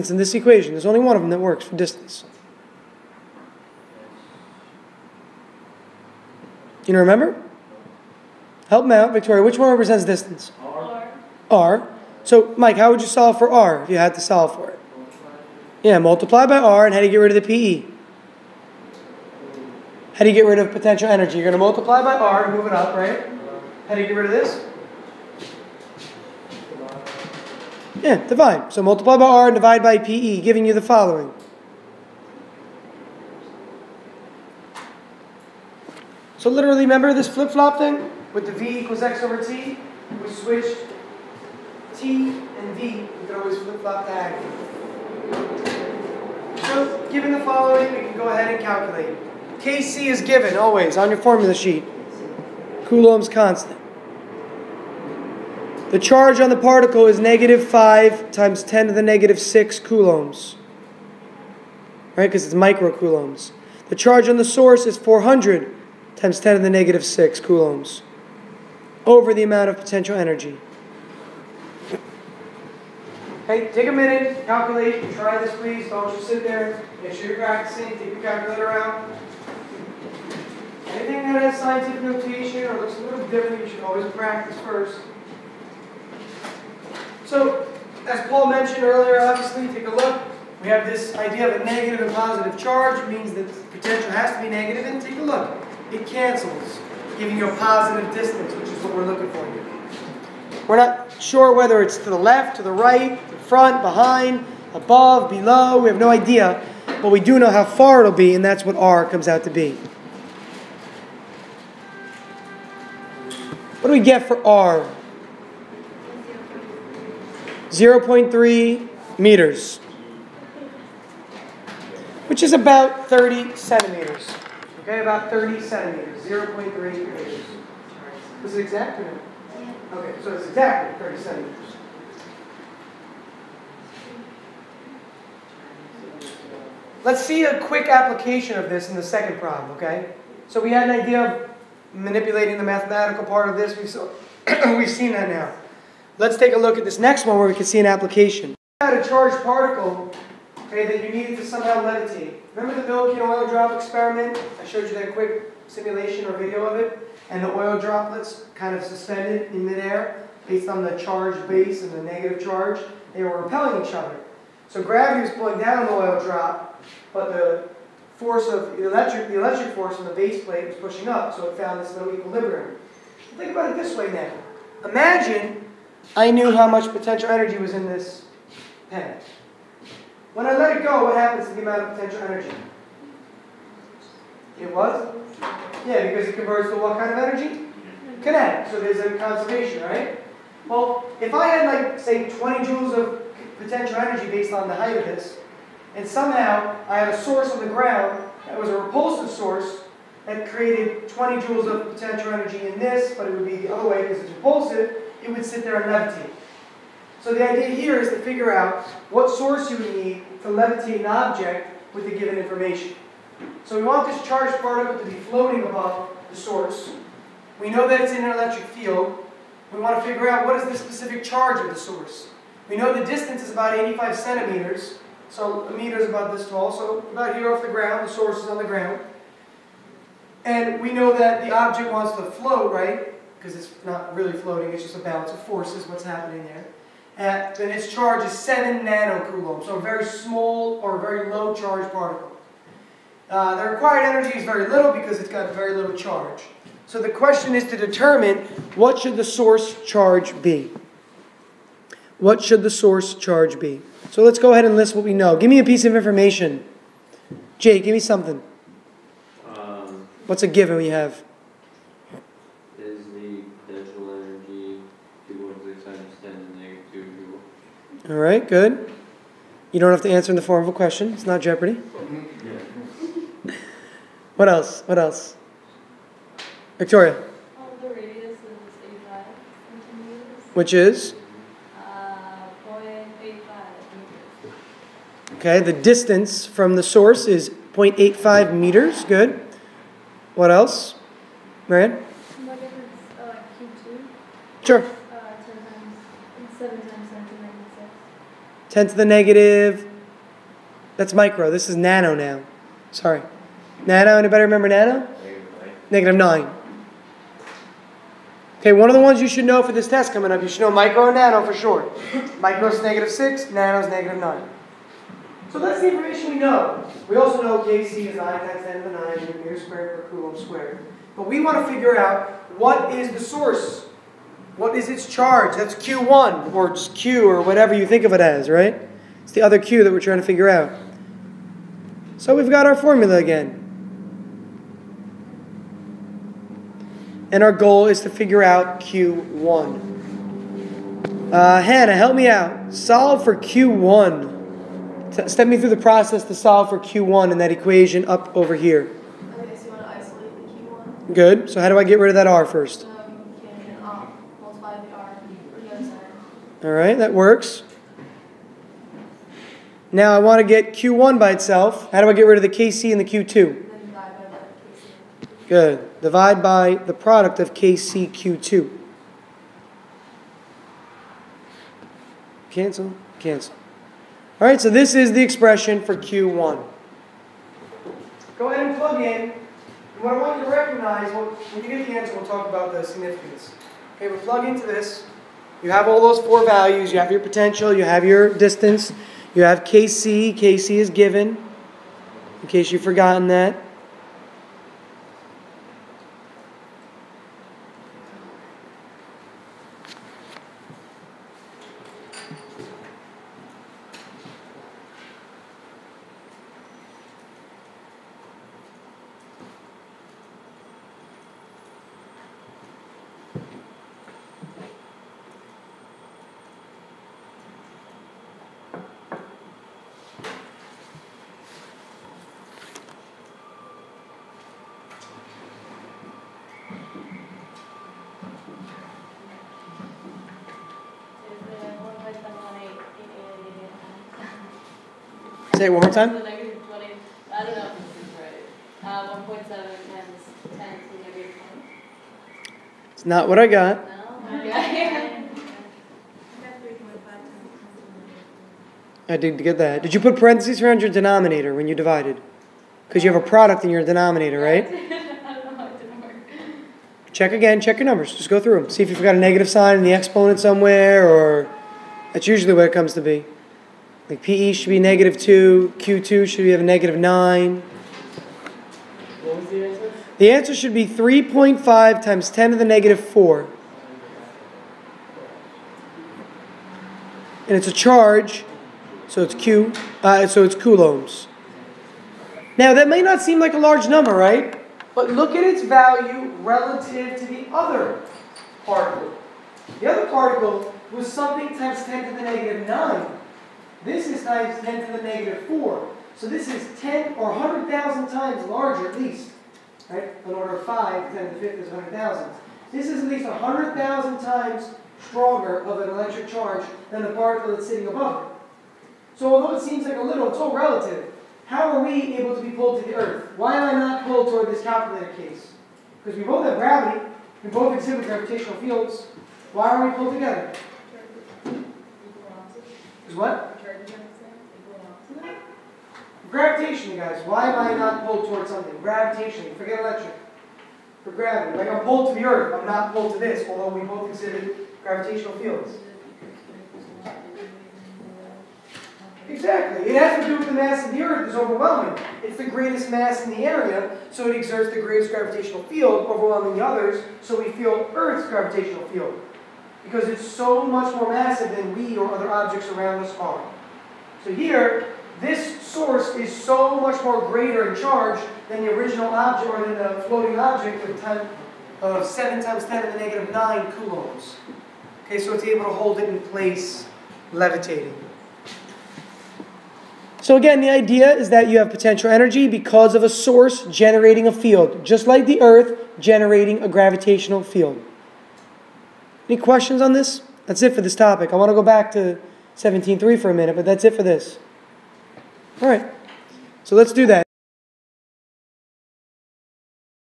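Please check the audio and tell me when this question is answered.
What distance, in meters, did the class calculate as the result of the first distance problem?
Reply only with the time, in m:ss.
1:57.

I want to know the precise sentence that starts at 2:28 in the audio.
had a charged particle okay, that you needed to somehow levitate.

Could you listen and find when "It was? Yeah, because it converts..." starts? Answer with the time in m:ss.
3:04.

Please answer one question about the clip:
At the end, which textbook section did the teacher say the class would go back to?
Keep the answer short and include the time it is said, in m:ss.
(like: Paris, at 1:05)
17.3, at 9:42.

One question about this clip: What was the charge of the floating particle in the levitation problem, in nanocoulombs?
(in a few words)
7 nanocoulombs.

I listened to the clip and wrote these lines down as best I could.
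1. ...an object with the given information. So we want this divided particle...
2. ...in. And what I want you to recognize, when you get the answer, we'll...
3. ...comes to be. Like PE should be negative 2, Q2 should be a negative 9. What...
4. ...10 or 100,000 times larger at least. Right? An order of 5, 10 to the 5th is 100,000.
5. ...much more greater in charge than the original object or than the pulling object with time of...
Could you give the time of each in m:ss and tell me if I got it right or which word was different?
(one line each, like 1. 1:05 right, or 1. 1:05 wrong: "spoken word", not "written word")
1. 3:30 wrong: "charged", not "divided"
2. 6:19 right
3. 7:42 right
4. 8:16 right
5. 9:16 wrong: "floating", not "pulling".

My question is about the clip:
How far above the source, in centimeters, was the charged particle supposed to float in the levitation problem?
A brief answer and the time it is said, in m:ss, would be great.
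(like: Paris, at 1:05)
85 centimeters, at 3:43.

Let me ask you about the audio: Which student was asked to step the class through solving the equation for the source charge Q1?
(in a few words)
Hannah.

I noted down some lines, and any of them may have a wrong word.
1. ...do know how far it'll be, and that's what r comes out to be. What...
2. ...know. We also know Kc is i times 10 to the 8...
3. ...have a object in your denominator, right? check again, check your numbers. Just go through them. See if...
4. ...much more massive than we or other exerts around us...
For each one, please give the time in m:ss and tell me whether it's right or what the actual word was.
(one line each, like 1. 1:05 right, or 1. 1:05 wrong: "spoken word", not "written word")
1. 1:47 right
2. 5:16 wrong: "9", not "8"
3. 7:33 wrong: "product", not "object"
4. 9:10 wrong: "objects", not "exerts".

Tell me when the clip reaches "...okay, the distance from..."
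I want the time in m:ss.
4:45.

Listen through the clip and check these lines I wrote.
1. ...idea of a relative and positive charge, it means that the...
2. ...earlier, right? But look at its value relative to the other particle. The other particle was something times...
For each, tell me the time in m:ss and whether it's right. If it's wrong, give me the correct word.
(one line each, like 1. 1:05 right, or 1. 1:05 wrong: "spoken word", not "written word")
1. 1:31 wrong: "negative", not "relative"
2. 8:03 wrong: "number", not "earlier".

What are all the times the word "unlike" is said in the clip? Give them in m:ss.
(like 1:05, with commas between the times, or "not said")
not said.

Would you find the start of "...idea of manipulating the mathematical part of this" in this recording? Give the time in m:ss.
2:21.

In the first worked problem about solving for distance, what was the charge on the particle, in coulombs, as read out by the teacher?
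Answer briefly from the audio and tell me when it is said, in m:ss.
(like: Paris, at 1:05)
-5 × 10^-6 coulombs, at 0:57.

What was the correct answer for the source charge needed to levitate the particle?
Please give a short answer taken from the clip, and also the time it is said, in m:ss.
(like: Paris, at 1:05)
3.5 × 10^-4 coulombs, at 7:50.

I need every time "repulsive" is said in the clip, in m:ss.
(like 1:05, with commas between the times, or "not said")
3:18, 3:24.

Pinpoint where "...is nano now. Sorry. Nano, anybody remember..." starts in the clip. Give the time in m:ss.
5:01.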